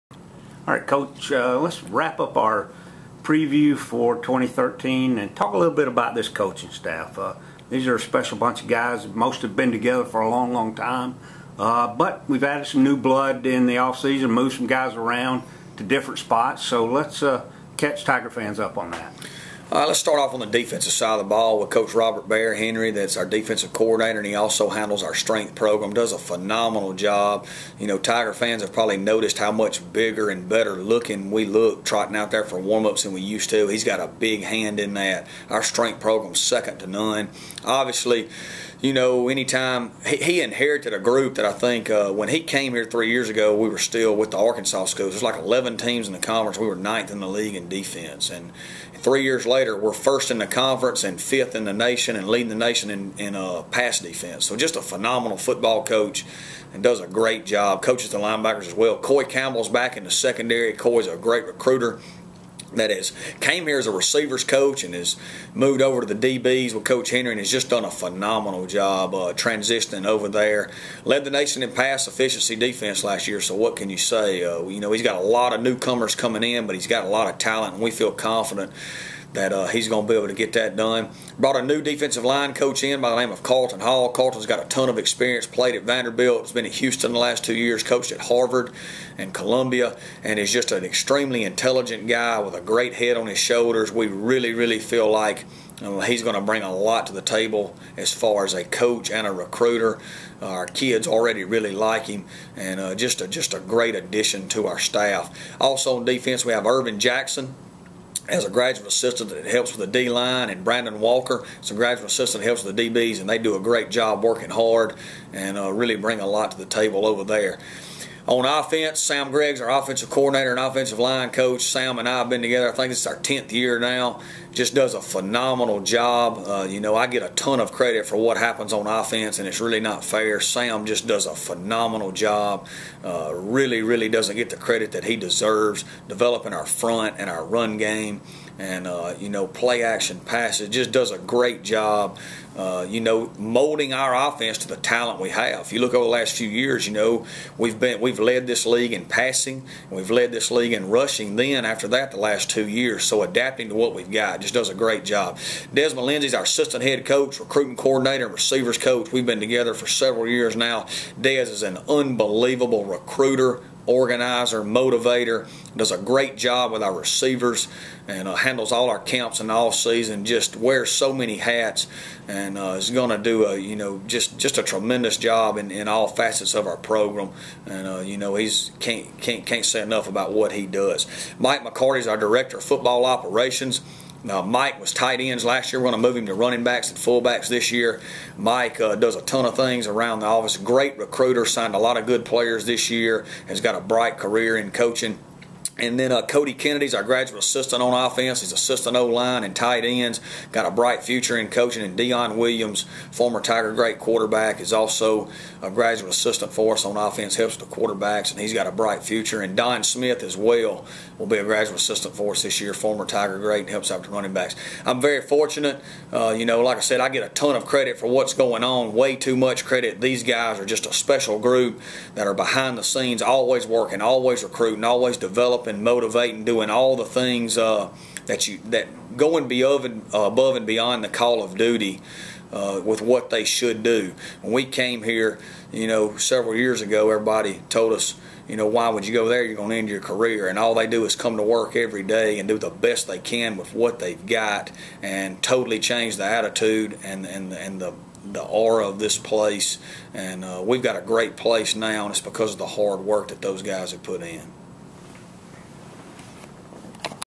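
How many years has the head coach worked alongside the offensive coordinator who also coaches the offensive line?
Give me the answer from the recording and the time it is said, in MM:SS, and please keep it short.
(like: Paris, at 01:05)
10, at 02:03.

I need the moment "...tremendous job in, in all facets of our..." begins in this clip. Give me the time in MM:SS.
02:54.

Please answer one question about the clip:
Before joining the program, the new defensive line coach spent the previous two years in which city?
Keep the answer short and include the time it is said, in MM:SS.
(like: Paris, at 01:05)
Houston, at 01:26.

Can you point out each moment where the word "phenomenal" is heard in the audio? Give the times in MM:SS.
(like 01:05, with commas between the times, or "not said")
00:26, 00:54, 01:07, 02:05, 02:11.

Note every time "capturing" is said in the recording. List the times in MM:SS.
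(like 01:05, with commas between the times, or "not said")
not said.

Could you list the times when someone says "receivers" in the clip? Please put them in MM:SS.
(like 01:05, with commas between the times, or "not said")
01:03, 02:38, 02:46.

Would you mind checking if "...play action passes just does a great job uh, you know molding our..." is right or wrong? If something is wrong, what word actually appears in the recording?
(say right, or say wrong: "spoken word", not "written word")
right.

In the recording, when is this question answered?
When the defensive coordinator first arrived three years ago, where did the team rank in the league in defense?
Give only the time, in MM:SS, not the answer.
00:46.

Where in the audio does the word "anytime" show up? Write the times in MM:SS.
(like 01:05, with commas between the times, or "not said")
00:39.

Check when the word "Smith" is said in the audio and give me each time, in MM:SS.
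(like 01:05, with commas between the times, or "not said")
03:29.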